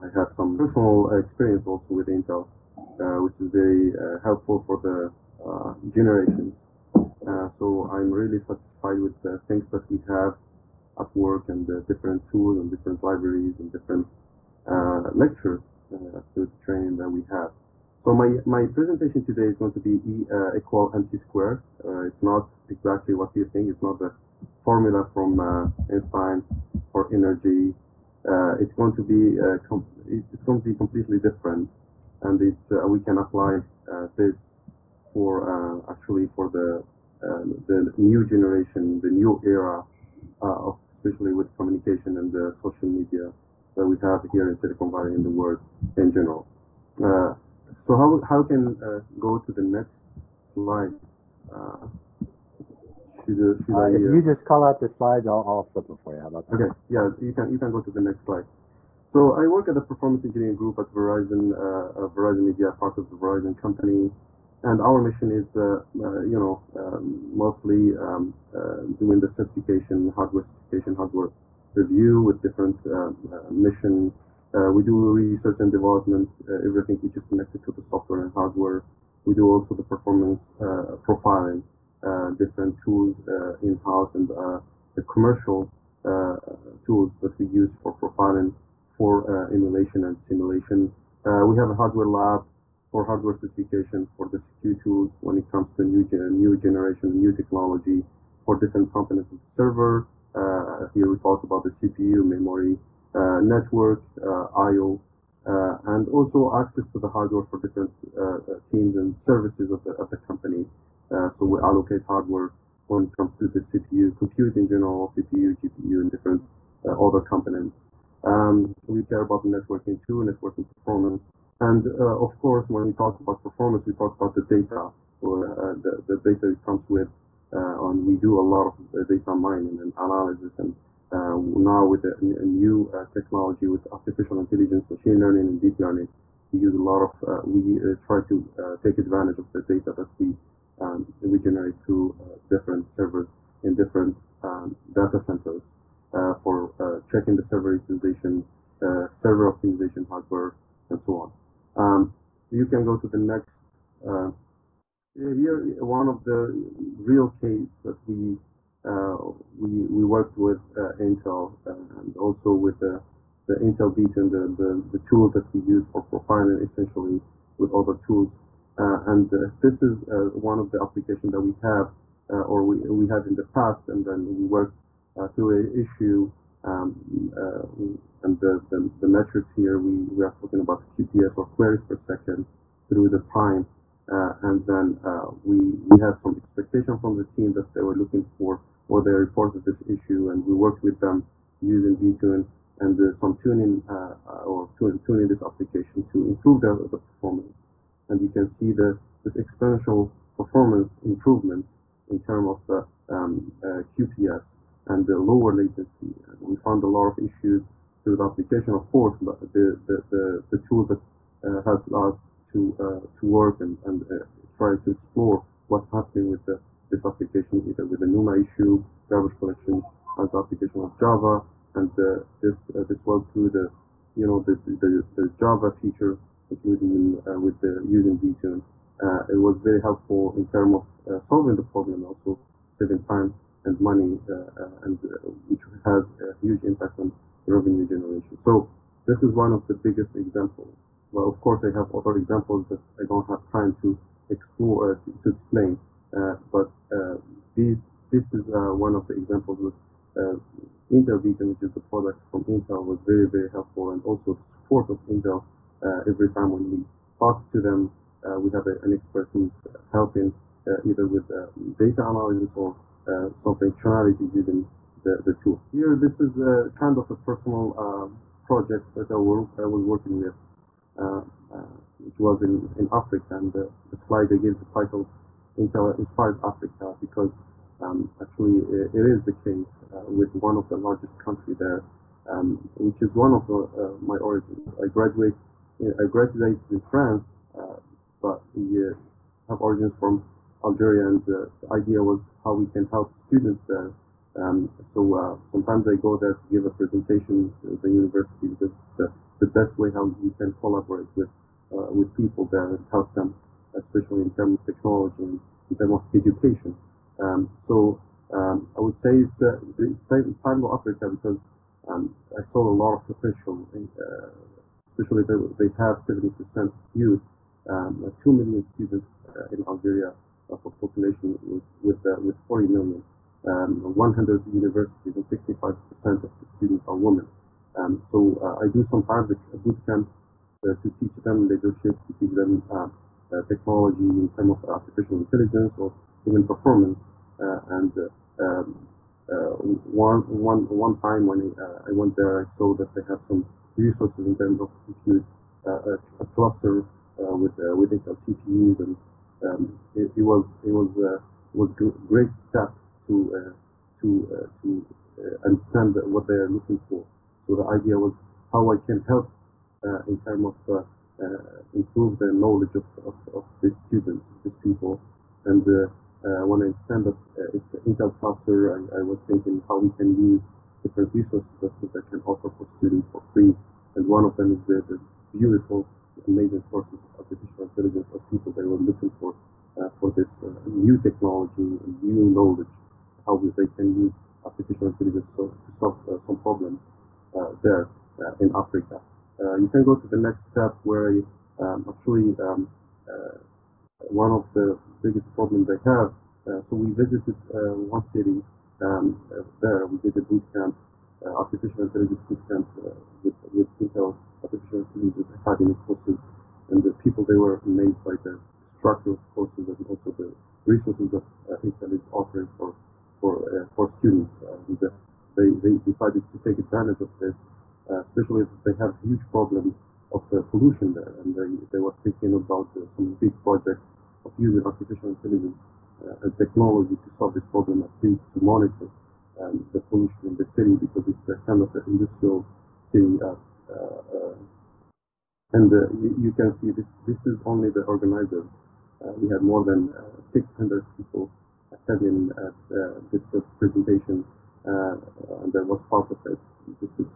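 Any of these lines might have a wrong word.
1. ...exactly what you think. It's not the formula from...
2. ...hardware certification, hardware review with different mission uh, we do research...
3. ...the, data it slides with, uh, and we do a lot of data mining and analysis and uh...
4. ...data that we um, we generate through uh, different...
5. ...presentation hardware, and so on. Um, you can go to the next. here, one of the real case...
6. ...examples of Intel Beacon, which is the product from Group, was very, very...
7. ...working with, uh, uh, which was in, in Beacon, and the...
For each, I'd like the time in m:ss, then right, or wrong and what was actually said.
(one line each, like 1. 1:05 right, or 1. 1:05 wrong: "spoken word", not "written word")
1. 0:22 right
2. 1:10 right
3. 2:06 wrong: "comes", not "slides"
4. 2:19 right
5. 2:29 wrong: "optimization", not "presentation"
6. 4:09 wrong: "Intel", not "Group"
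7. 4:29 wrong: "Africa", not "Beacon".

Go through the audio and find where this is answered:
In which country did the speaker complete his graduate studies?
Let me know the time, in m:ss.
4:46.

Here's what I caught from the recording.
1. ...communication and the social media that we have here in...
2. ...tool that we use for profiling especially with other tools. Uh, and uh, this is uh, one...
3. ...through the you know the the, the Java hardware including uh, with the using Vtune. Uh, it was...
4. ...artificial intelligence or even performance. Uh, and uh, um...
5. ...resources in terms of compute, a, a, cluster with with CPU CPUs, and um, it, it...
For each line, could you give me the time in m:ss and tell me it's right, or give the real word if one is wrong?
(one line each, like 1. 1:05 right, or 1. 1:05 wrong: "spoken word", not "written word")
1. 0:41 right
2. 2:45 wrong: "essentially", not "especially"
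3. 3:43 wrong: "feature", not "hardware"
4. 5:34 right
5. 5:43 wrong: "Intel", not "CPU".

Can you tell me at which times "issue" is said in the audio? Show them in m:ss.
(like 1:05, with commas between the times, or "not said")
2:55, 3:09, 3:27, 3:38.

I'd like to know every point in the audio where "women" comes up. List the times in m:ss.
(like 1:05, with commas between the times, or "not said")
5:26.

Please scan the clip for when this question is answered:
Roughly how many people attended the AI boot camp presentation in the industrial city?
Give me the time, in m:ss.
7:19.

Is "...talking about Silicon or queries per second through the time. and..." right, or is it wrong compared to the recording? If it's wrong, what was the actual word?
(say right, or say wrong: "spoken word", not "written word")
wrong: "QPS", not "Silicon".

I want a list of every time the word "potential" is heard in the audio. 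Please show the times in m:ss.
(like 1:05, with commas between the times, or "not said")
5:13.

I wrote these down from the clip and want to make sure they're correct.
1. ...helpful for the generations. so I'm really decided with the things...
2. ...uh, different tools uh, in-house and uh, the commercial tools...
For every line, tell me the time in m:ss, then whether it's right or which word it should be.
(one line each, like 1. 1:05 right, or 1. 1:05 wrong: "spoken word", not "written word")
1. 0:04 wrong: "satisfied", not "decided"
2. 1:22 right.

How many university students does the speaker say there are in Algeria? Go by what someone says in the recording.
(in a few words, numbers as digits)
2 million.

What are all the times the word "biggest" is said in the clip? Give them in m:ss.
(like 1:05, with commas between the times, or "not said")
3:59, 6:35.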